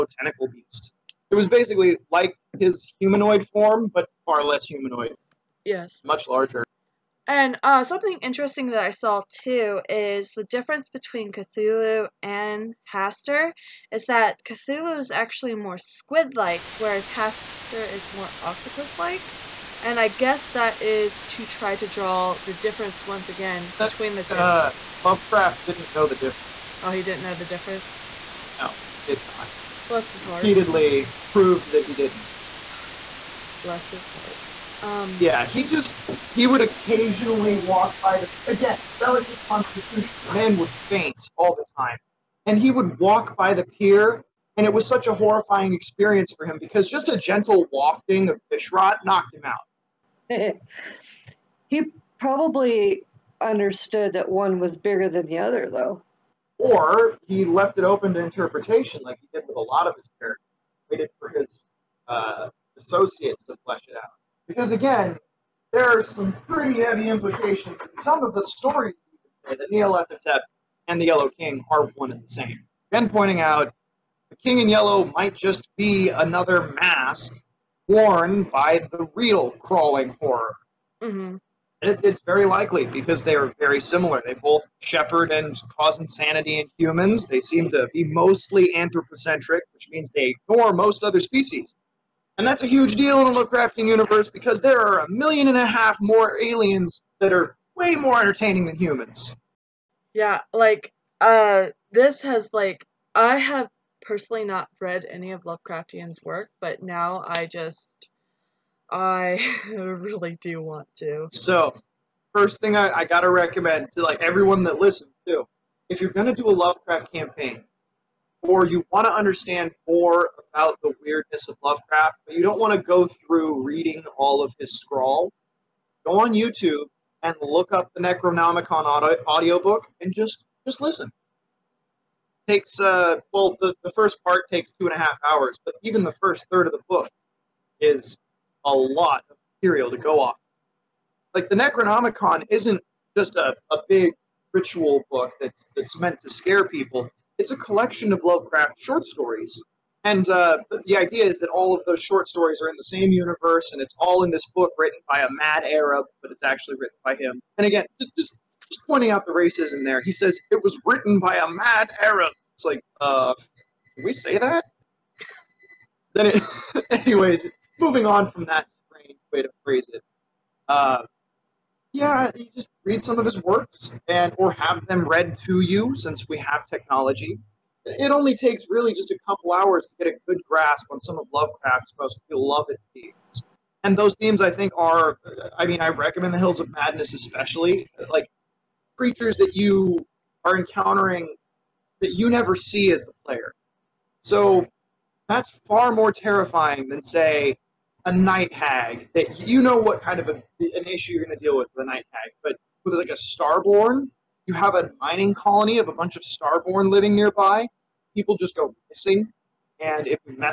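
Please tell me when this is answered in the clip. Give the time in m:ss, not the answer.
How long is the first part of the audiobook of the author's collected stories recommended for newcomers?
2:14.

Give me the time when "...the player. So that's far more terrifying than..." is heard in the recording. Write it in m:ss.
3:13.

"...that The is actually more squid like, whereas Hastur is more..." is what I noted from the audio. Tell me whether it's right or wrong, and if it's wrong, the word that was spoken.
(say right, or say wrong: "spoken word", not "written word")
wrong: "Cthulhu", not "The".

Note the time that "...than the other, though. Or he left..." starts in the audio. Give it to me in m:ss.
0:55.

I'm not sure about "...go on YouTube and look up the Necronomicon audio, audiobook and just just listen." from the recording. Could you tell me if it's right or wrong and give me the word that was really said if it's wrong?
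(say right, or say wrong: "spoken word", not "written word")
right.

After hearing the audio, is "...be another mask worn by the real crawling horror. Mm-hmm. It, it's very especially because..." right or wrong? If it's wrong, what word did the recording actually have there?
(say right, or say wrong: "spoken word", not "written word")
wrong: "likely", not "especially".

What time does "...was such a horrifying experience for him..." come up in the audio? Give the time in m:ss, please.
0:44.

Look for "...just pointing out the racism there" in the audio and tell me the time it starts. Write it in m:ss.
2:38.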